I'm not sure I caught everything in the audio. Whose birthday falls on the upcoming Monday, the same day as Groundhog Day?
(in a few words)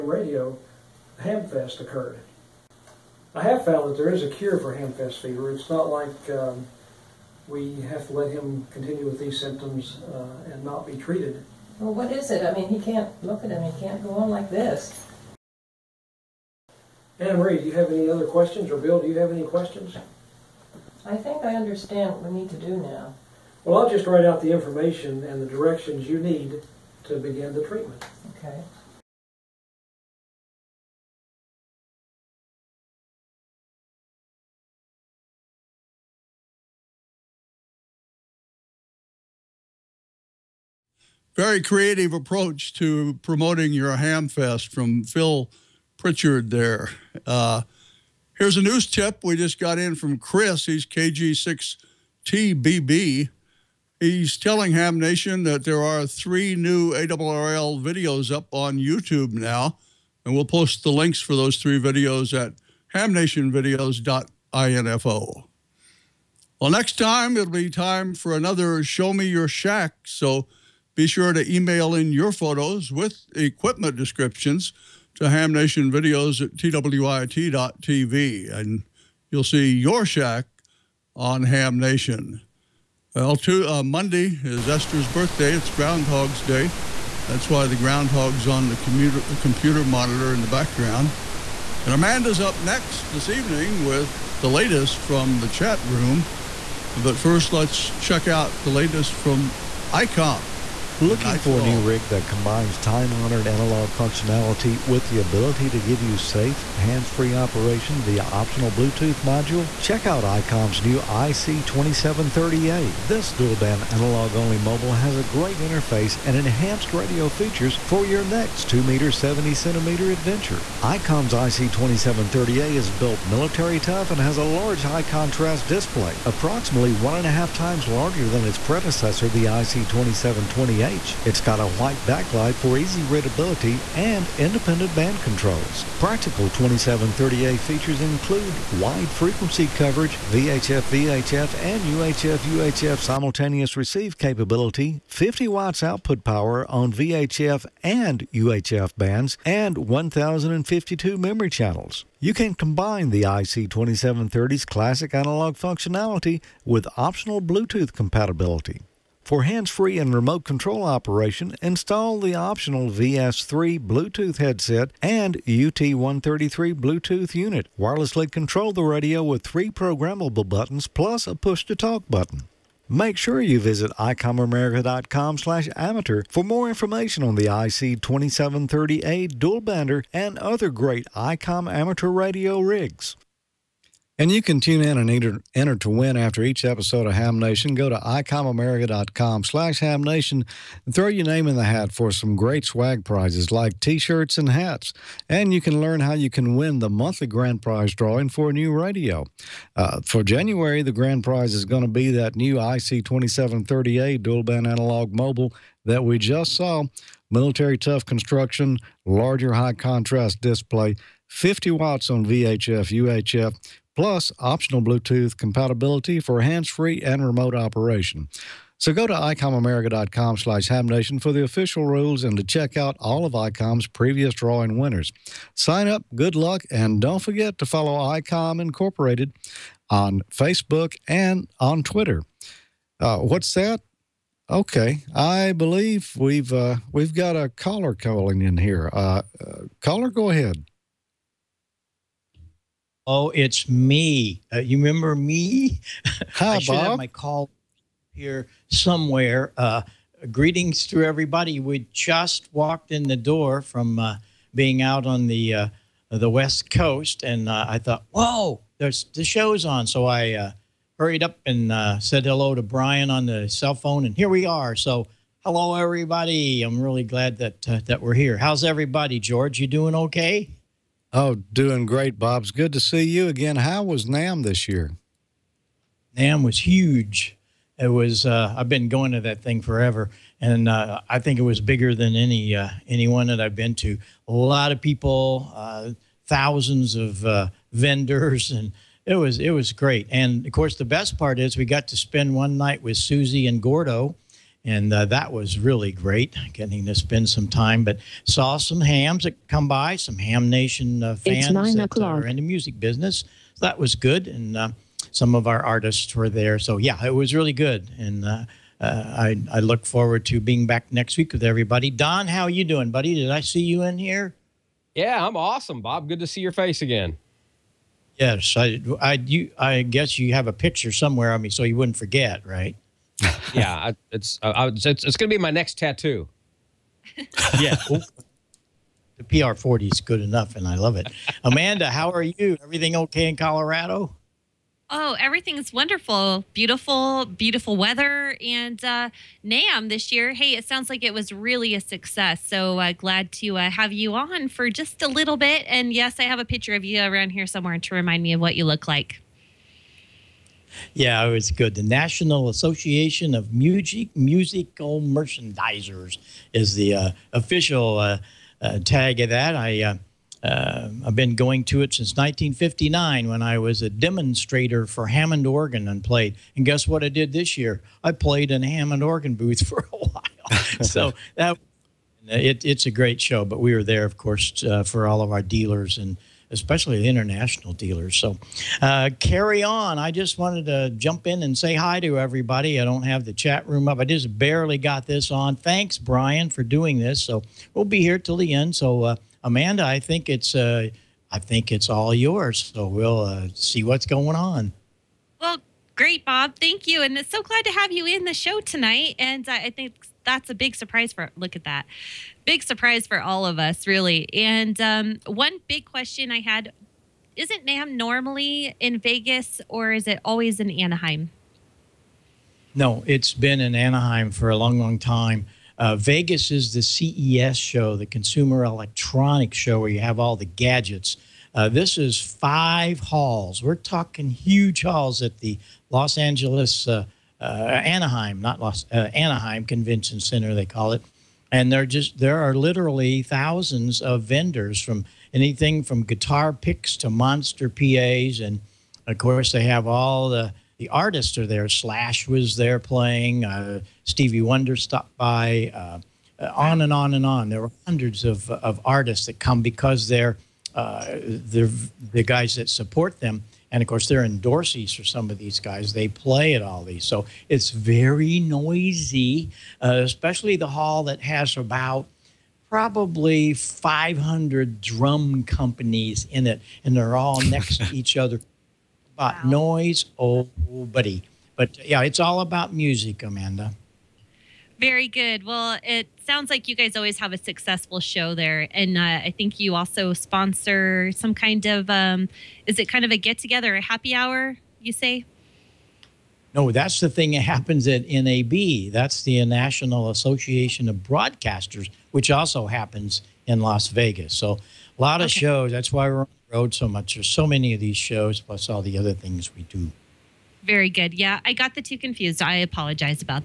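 Esther.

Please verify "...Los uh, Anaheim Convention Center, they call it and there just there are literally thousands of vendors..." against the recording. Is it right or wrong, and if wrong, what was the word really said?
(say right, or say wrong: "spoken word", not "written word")
right.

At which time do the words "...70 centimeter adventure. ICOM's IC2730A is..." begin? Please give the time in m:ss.
1:59.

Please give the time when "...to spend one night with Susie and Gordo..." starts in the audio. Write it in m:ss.
4:51.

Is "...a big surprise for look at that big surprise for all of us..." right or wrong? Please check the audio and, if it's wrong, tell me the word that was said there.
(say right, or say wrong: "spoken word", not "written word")
right.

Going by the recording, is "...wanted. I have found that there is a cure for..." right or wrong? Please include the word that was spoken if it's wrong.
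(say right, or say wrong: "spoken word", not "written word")
wrong: "occurred", not "wanted".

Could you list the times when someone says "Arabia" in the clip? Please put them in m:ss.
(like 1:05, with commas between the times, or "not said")
not said.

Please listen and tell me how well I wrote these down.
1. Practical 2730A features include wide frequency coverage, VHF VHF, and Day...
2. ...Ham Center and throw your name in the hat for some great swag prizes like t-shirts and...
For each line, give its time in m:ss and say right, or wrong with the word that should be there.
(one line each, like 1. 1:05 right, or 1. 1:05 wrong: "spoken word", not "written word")
1. 2:15 wrong: "UHF", not "Day"
2. 3:09 wrong: "Nation", not "Center".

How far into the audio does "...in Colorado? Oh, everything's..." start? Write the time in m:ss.
5:33.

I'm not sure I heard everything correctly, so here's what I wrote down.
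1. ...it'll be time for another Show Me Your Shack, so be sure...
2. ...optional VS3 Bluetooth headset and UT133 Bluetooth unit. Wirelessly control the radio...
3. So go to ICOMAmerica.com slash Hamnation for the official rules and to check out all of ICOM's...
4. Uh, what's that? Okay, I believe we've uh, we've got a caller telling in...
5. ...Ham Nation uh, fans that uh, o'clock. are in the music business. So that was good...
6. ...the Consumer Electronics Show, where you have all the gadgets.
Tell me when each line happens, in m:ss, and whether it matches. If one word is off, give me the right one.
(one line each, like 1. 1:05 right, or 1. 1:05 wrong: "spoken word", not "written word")
1. 1:07 right
2. 2:42 right
3. 3:38 right
4. 3:52 wrong: "calling", not "telling"
5. 5:00 right
6. 6:57 right.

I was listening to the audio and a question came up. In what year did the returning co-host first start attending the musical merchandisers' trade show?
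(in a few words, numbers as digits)
1959.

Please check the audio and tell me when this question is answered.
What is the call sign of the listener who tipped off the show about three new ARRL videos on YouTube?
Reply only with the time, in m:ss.
0:50.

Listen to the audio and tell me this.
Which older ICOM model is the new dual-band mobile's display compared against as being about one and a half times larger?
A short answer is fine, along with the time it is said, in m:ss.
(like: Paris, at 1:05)
IC2720H, at 2:09.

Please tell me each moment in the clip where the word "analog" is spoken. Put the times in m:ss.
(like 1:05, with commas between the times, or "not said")
1:43, 1:53, 2:35, 3:24.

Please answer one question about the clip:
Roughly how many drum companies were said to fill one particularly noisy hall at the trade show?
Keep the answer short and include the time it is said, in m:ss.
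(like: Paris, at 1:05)
500, at 7:43.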